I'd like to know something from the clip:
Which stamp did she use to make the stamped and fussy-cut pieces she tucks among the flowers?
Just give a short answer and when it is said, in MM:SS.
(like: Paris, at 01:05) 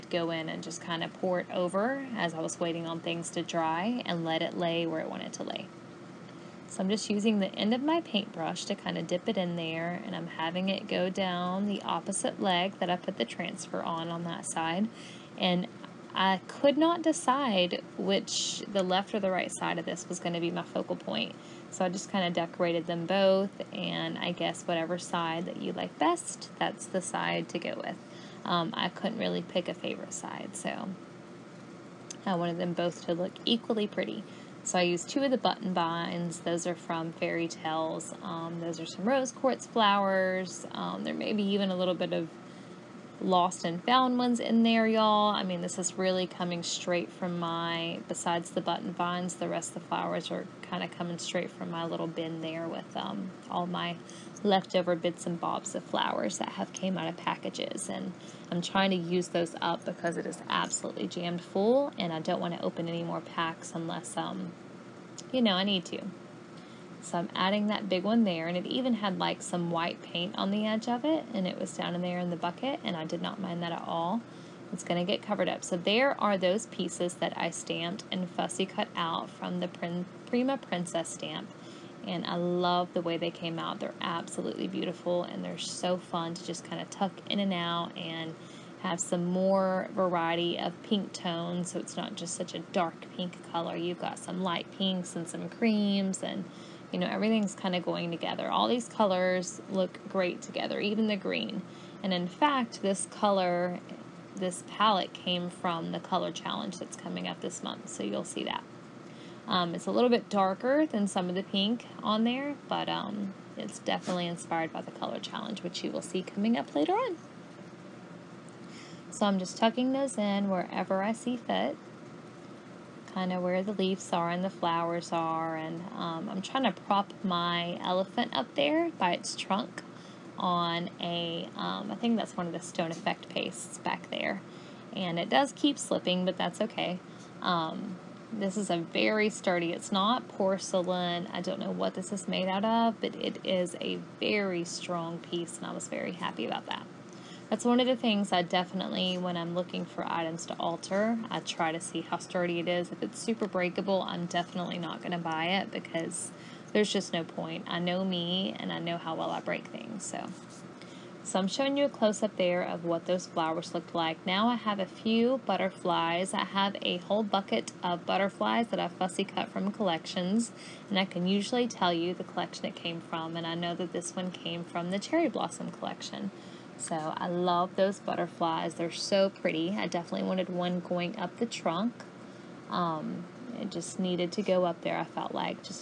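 Prima Princess stamp, at 01:19.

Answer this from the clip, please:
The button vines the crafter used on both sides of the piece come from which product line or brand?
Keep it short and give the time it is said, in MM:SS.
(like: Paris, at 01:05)
Fairy Tales, at 00:37.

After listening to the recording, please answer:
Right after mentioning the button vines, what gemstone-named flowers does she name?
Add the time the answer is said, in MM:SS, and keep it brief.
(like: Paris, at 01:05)
Rose quartz, at 00:39.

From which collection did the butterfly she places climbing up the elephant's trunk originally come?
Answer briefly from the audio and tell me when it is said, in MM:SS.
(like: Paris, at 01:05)
Cherry Blossom, at 02:54.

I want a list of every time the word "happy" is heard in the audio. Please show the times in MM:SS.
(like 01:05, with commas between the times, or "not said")
02:26.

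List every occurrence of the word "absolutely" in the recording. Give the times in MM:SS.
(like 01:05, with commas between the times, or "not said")
01:00, 01:23.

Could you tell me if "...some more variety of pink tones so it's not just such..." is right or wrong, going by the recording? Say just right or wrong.
right.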